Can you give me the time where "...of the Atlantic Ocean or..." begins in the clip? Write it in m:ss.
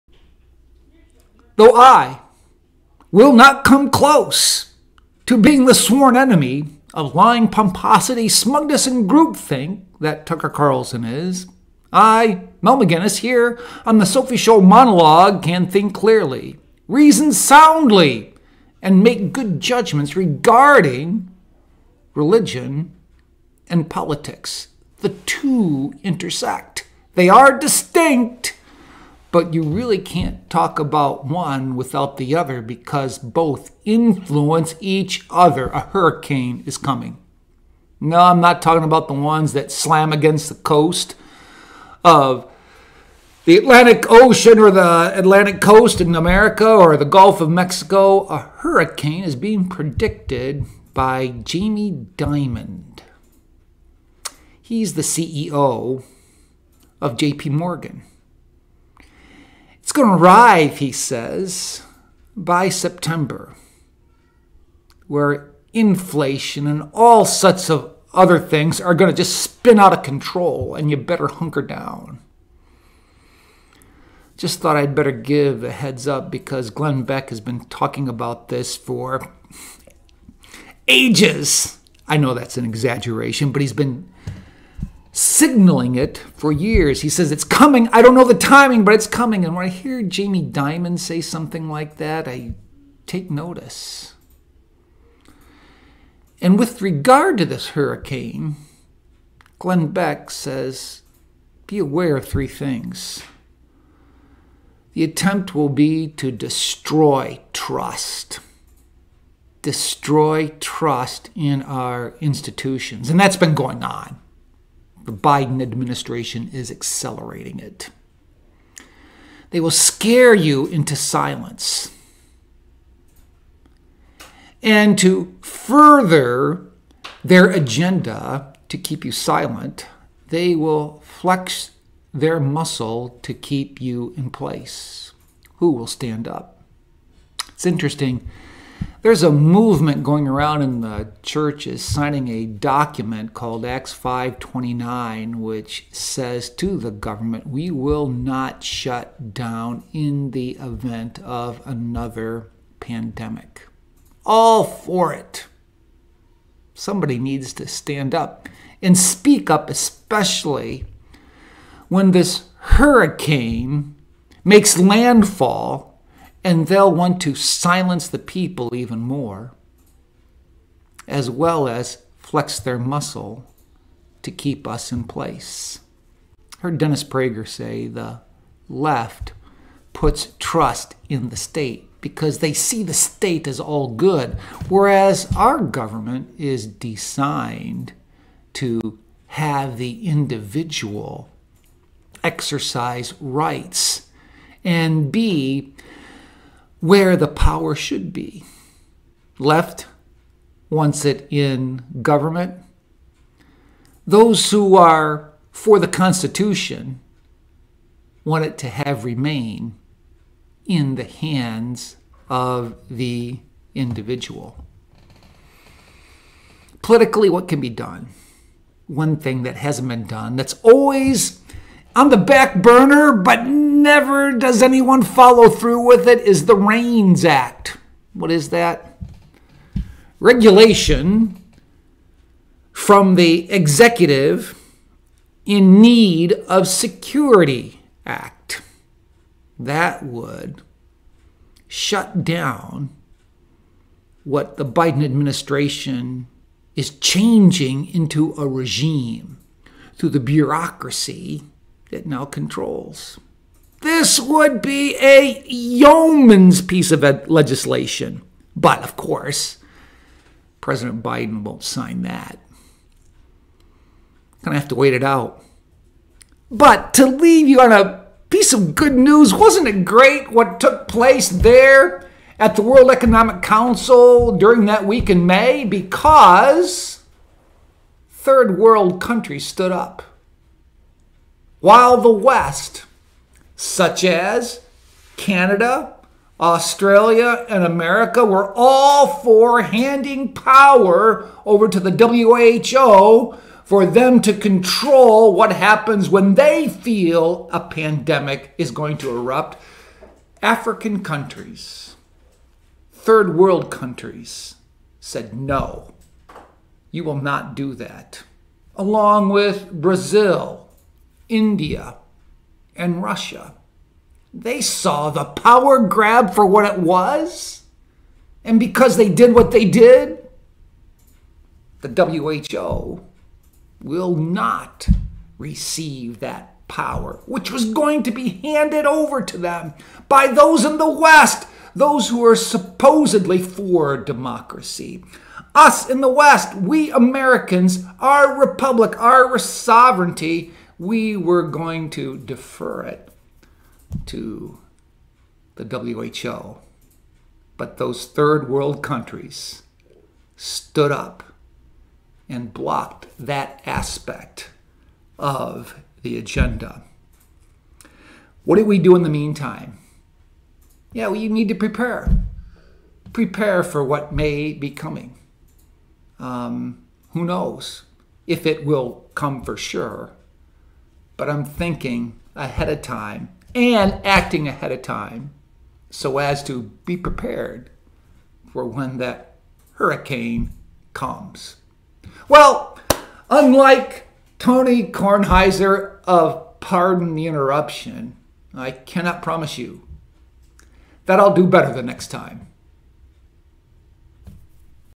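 0:42.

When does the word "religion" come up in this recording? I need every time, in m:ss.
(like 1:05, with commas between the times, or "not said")
0:22.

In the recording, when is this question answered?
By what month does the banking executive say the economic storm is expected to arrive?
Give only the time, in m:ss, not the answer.
1:02.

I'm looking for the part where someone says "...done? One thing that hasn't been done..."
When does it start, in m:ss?
3:37.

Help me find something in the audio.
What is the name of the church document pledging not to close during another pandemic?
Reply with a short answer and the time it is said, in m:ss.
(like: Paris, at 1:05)
Acts 529, at 2:23.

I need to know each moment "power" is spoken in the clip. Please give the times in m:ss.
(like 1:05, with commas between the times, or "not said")
3:17, 4:50, 5:15, 5:26.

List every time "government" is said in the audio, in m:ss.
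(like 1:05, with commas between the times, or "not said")
2:26, 3:05, 3:22.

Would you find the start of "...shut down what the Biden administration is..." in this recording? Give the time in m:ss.
4:01.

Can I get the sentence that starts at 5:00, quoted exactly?
African countries, third world countries said no, you will not do that.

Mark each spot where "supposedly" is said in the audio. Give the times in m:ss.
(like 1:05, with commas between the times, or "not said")
5:32.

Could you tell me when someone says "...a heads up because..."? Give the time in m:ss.
1:15.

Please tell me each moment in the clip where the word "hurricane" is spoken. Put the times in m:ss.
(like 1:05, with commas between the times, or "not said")
0:35, 0:48, 1:37, 2:42, 6:19.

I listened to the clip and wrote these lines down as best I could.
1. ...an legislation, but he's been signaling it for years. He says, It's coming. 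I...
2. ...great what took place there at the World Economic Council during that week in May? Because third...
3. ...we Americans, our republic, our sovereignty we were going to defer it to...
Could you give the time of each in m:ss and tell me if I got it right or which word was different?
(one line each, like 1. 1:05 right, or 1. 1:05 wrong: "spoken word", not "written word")
1. 1:22 wrong: "exaggeration", not "legislation"
2. 4:29 right
3. 5:36 right.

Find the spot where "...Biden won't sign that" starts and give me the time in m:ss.
4:21.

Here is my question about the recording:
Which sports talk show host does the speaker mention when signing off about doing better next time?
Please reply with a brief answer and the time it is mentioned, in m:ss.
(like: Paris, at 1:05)
Tony Kornheiser, at 6:24.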